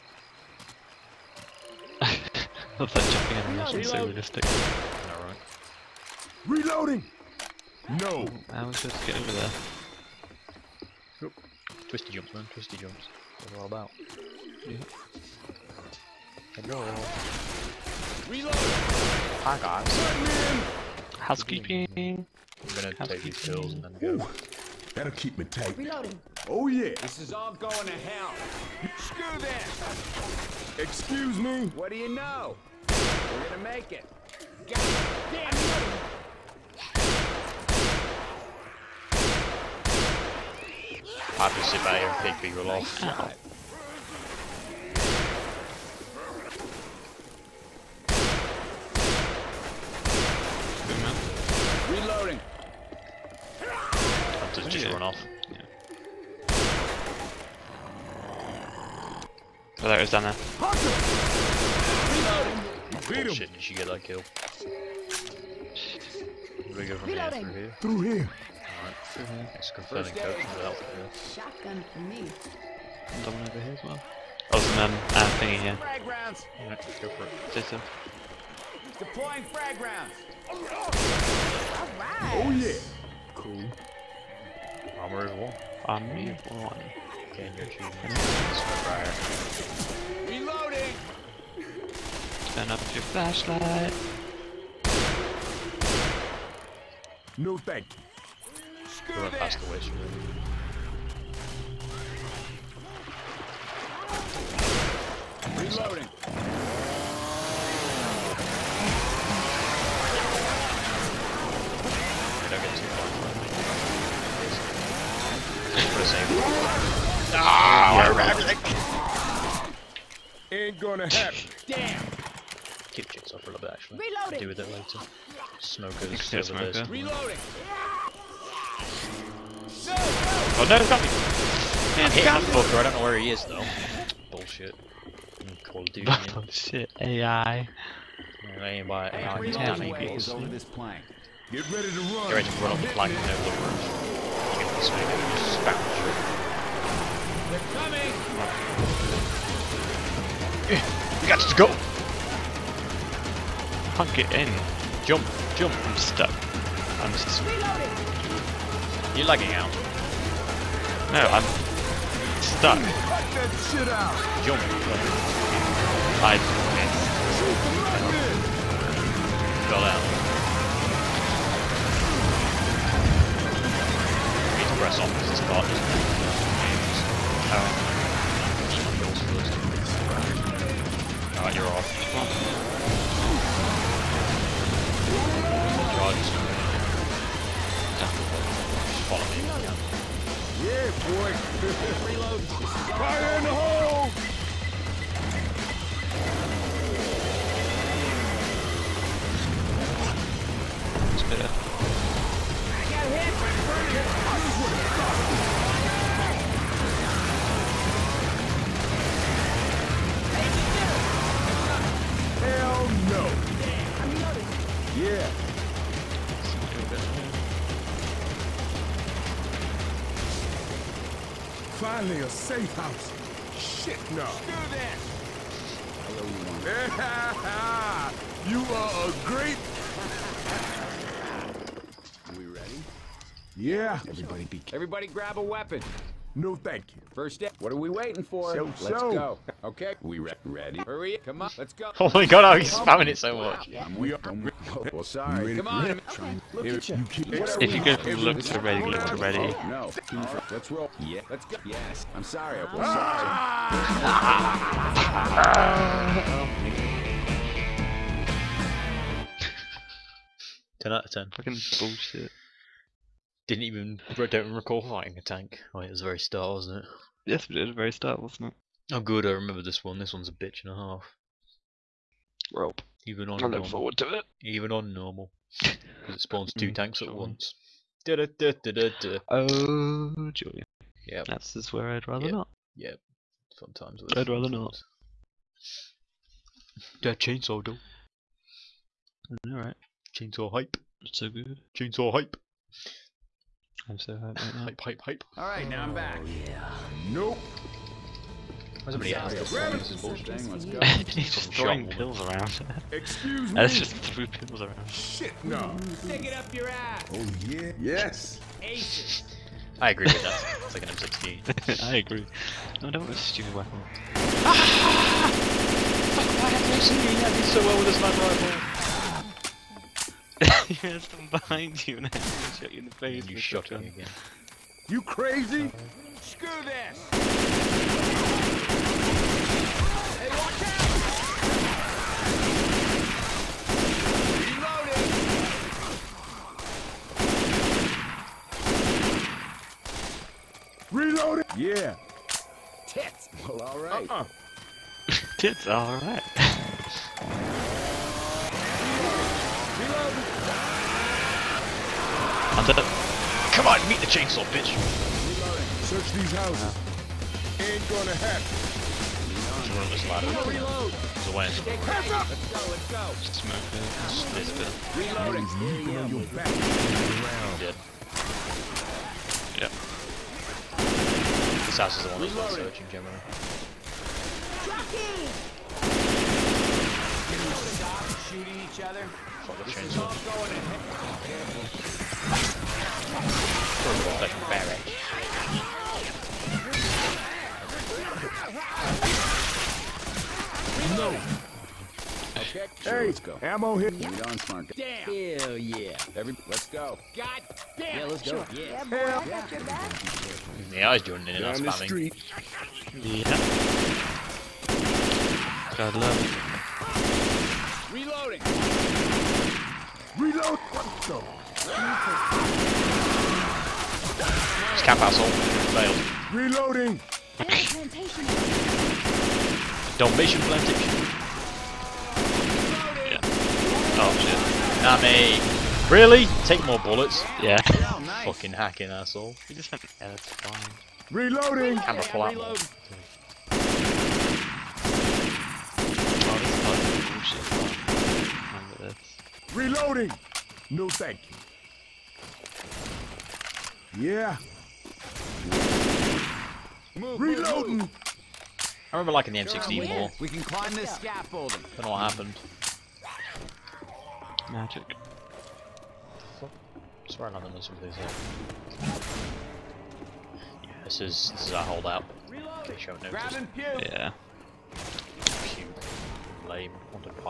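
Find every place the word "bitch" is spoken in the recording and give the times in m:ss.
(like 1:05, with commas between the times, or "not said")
4:30, 5:54.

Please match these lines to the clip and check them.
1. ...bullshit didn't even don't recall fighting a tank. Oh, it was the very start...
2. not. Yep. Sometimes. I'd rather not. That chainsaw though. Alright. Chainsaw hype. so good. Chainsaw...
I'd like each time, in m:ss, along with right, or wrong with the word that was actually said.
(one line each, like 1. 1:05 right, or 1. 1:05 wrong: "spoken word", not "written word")
1. 4:21 right
2. 4:42 right.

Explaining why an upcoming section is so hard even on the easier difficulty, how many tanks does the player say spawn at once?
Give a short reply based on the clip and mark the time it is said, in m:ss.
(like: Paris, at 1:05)
2, at 4:36.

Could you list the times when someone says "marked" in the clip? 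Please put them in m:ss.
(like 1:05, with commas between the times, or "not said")
not said.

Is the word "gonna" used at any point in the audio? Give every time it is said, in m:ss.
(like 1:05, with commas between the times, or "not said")
0:22, 0:33, 2:00, 5:57.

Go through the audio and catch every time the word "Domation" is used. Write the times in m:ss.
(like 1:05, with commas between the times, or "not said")
6:59.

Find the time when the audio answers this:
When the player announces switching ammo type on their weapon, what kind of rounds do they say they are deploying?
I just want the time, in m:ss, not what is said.
1:19.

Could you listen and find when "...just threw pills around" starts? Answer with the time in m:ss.
5:03.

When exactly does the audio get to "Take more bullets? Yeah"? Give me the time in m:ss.
7:06.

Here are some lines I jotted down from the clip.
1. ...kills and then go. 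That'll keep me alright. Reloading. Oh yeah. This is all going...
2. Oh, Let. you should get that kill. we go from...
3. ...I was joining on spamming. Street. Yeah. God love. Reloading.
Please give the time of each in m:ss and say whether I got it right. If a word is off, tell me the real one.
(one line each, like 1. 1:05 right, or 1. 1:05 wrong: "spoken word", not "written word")
1. 0:23 wrong: "tight", not "alright"
2. 1:00 wrong: "Reloading", not "Let"
3. 6:40 right.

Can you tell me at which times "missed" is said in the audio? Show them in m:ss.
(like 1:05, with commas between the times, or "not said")
2:46.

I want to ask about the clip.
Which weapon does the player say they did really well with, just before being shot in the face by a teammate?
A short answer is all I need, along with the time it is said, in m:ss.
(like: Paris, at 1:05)
sniper rifle, at 5:17.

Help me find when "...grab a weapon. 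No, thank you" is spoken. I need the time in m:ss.
3:55.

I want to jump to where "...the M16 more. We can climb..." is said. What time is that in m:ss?
7:29.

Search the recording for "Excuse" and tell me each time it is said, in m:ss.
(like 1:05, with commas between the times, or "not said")
0:30, 5:02.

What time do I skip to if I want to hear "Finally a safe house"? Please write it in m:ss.
3:42.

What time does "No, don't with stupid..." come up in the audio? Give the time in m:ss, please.
5:12.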